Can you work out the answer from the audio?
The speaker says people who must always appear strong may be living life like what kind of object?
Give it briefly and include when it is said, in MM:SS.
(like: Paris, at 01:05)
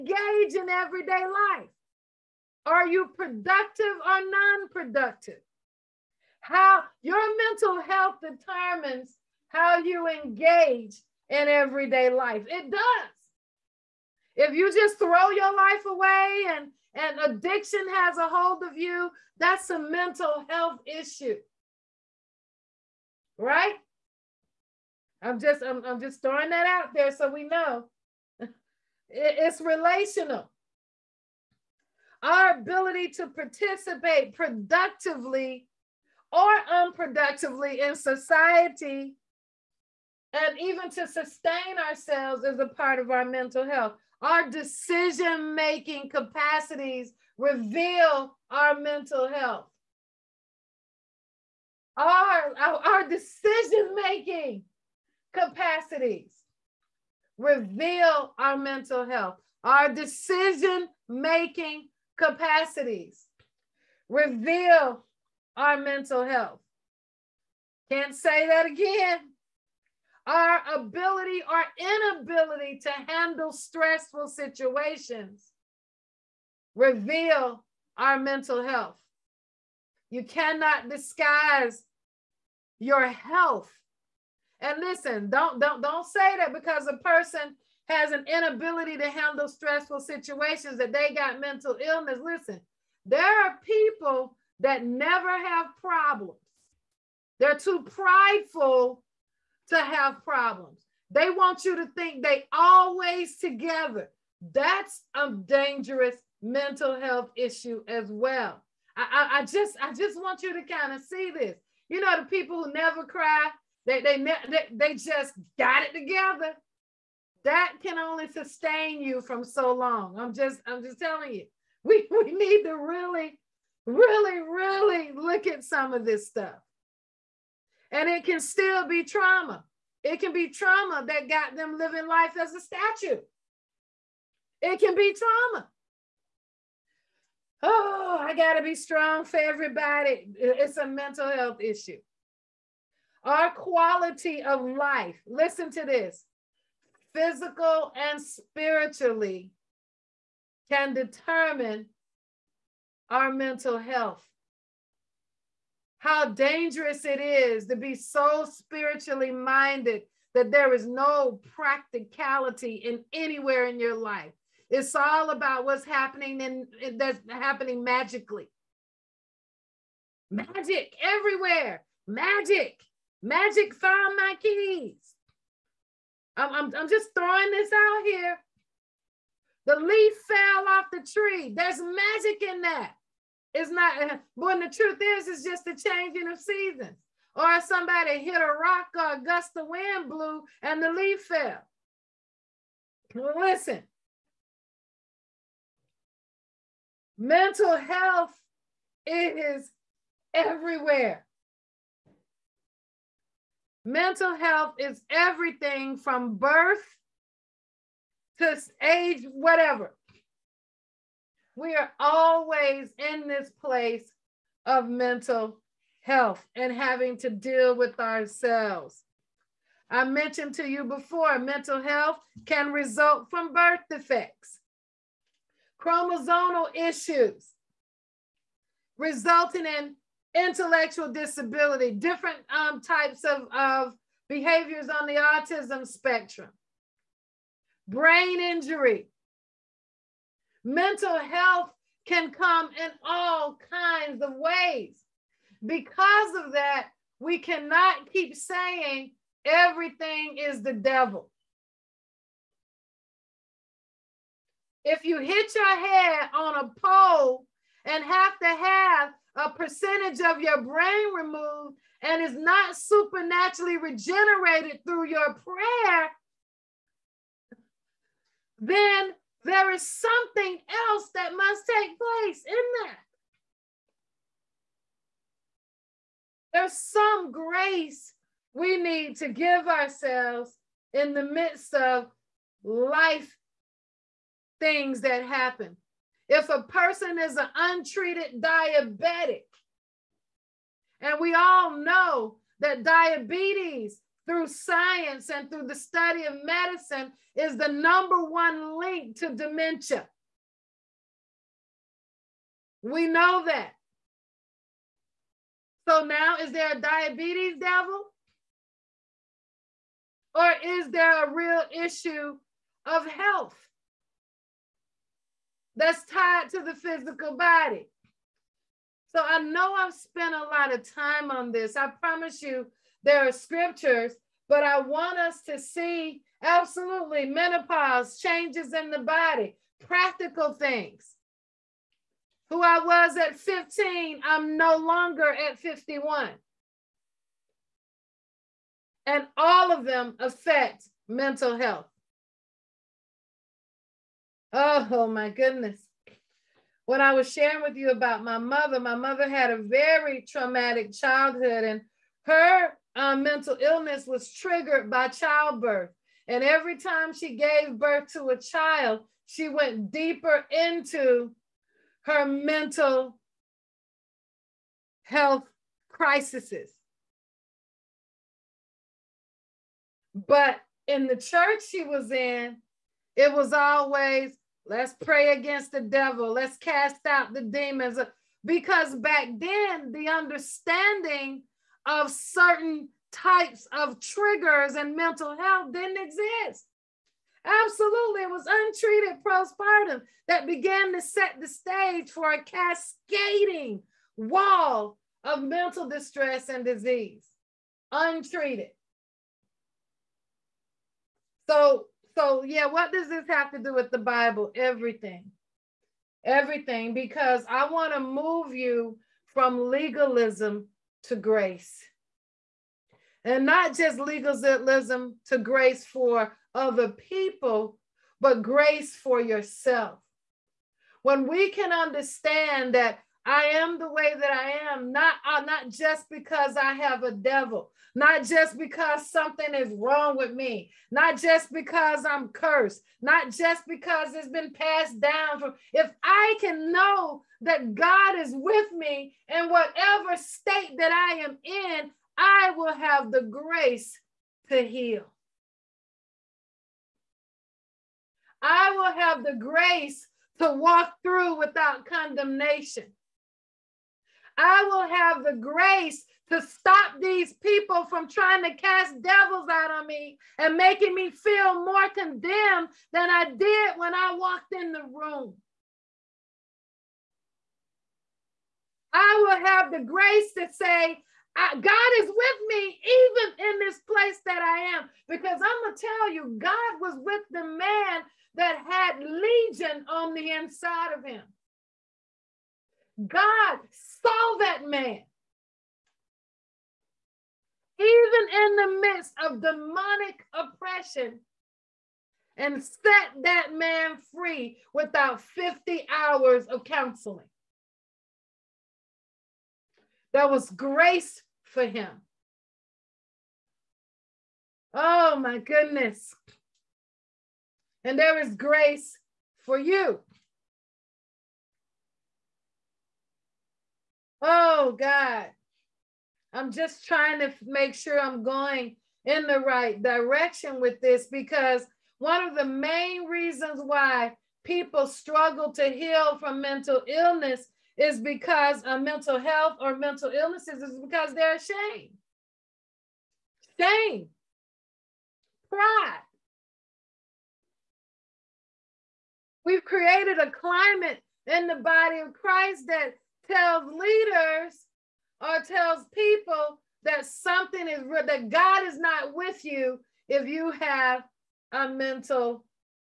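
a statue, at 02:12.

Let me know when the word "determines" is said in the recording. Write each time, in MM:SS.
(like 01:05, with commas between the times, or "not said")
00:08, 02:30.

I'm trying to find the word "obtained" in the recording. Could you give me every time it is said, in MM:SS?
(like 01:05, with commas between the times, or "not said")
not said.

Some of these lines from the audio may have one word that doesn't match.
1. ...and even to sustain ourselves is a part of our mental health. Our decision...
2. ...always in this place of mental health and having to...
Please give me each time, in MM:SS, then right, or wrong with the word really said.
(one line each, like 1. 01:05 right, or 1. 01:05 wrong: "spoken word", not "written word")
1. 00:40 right
2. 03:31 right.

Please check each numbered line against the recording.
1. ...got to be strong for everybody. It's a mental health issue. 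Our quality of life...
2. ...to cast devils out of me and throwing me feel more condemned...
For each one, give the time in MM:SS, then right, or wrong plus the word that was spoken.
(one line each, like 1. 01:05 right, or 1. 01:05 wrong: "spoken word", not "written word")
1. 02:18 right
2. 07:38 wrong: "making", not "throwing".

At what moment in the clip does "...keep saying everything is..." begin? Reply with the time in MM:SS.
04:08.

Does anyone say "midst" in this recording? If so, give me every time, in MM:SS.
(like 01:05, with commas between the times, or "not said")
04:41, 08:08.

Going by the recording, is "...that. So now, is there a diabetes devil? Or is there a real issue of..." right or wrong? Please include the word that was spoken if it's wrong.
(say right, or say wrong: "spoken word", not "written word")
right.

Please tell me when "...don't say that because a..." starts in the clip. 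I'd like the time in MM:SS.
01:25.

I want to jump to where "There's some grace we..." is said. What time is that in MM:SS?
04:36.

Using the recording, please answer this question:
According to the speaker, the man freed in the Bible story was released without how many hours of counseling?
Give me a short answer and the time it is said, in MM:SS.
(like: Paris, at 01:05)
50, at 08:15.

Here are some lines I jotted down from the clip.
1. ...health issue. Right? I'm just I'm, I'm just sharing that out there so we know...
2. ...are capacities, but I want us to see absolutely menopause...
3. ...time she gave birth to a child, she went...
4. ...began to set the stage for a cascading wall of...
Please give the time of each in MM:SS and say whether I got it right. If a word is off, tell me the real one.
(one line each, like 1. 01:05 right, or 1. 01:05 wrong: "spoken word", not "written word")
1. 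00:20 wrong: "throwing", not "sharing"
2. 05:23 wrong: "scriptures", not "capacities"
3. 05:56 right
4. 06:30 right.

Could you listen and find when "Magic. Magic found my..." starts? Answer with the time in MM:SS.
02:52.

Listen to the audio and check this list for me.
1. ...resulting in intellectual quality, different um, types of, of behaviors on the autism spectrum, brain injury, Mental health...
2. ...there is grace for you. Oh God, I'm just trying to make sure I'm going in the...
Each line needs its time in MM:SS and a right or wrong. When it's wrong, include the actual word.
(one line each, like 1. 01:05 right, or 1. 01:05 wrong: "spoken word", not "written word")
1. 03:48 wrong: "disability", not "quality"
2. 08:27 right.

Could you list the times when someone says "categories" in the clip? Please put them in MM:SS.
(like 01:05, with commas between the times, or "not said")
not said.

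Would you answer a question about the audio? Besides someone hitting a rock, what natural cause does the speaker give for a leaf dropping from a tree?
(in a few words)
a gust of wind.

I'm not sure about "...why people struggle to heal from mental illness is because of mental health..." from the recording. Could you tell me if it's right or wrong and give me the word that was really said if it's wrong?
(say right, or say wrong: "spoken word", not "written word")
right.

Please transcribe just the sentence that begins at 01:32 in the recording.
Listen, there are people that never have problems.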